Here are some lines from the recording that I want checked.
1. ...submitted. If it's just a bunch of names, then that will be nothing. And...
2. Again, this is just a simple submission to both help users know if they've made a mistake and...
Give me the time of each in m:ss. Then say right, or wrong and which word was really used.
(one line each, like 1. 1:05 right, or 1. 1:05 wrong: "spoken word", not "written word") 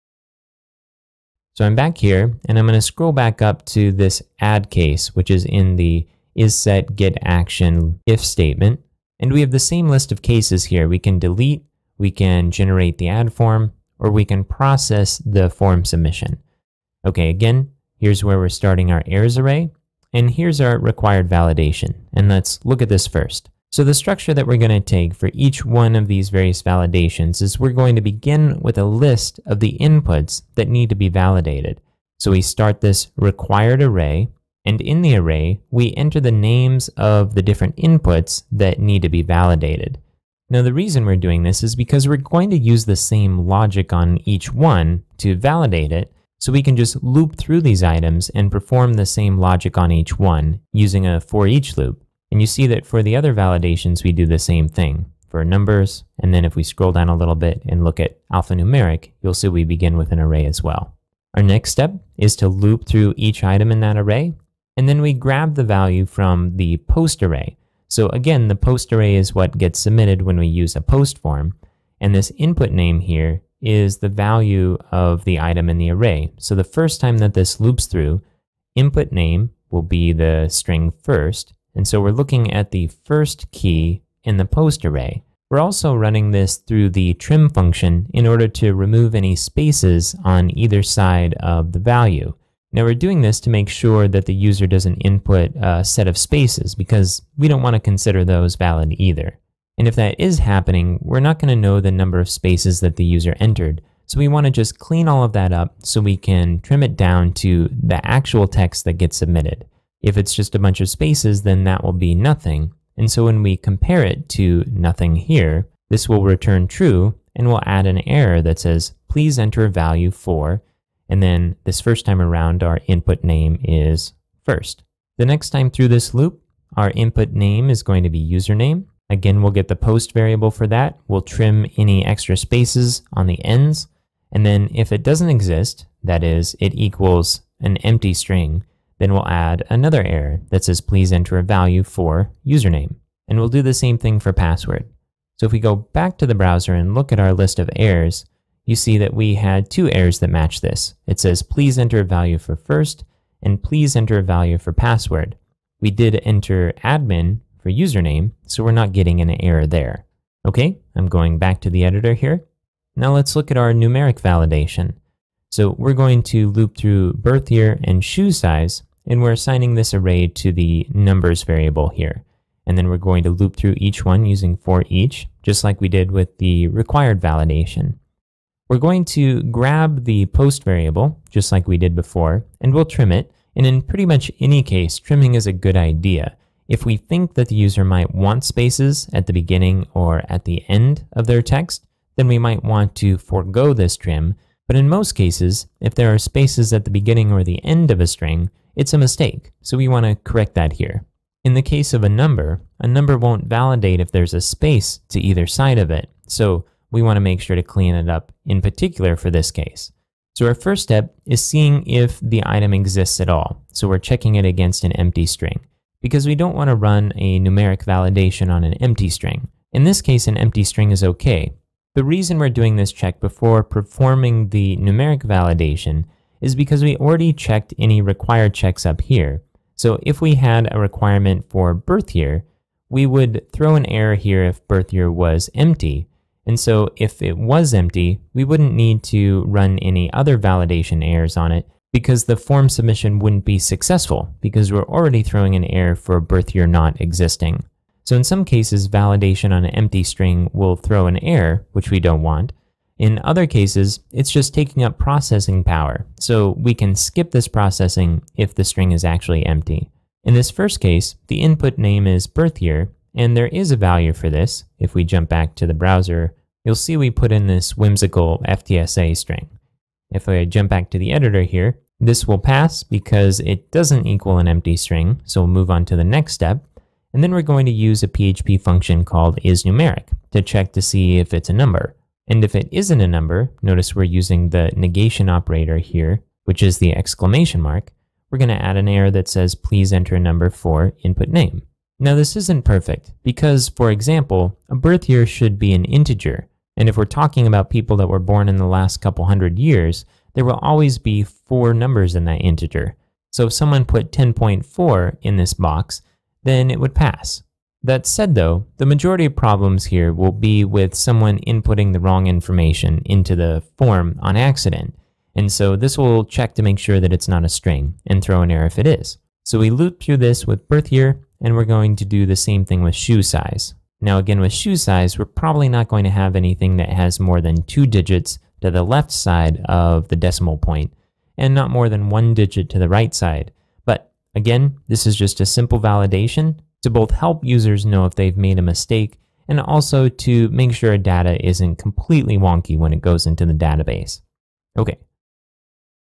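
1. 1:49 wrong: "spaces", not "names"
2. 5:34 wrong: "validation", not "submission".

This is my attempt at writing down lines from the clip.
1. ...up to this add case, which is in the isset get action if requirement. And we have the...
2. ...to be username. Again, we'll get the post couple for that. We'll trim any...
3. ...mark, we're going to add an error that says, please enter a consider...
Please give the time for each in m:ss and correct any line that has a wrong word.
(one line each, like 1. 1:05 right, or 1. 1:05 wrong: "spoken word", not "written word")
1. 0:03 wrong: "statement", not "requirement"
2. 2:08 wrong: "variable", not "couple"
3. 4:47 wrong: "number", not "consider".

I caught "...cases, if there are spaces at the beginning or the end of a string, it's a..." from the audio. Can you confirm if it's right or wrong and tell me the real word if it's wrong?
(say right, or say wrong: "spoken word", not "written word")
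right.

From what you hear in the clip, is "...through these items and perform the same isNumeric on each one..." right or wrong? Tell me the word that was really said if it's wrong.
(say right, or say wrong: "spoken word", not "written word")
wrong: "logic", not "isNumeric".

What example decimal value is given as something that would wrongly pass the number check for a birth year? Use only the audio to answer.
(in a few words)
10.4.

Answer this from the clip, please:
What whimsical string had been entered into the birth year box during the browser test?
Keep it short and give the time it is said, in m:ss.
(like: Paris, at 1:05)
FTSA, at 4:28.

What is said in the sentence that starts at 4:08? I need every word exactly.
So in some cases, validation on an empty string will throw an error, which we don't want.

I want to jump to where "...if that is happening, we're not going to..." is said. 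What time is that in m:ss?
1:39.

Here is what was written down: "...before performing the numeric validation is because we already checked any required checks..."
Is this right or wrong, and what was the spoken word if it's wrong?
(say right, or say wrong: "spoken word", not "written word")
right.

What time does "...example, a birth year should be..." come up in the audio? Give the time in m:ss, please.
4:53.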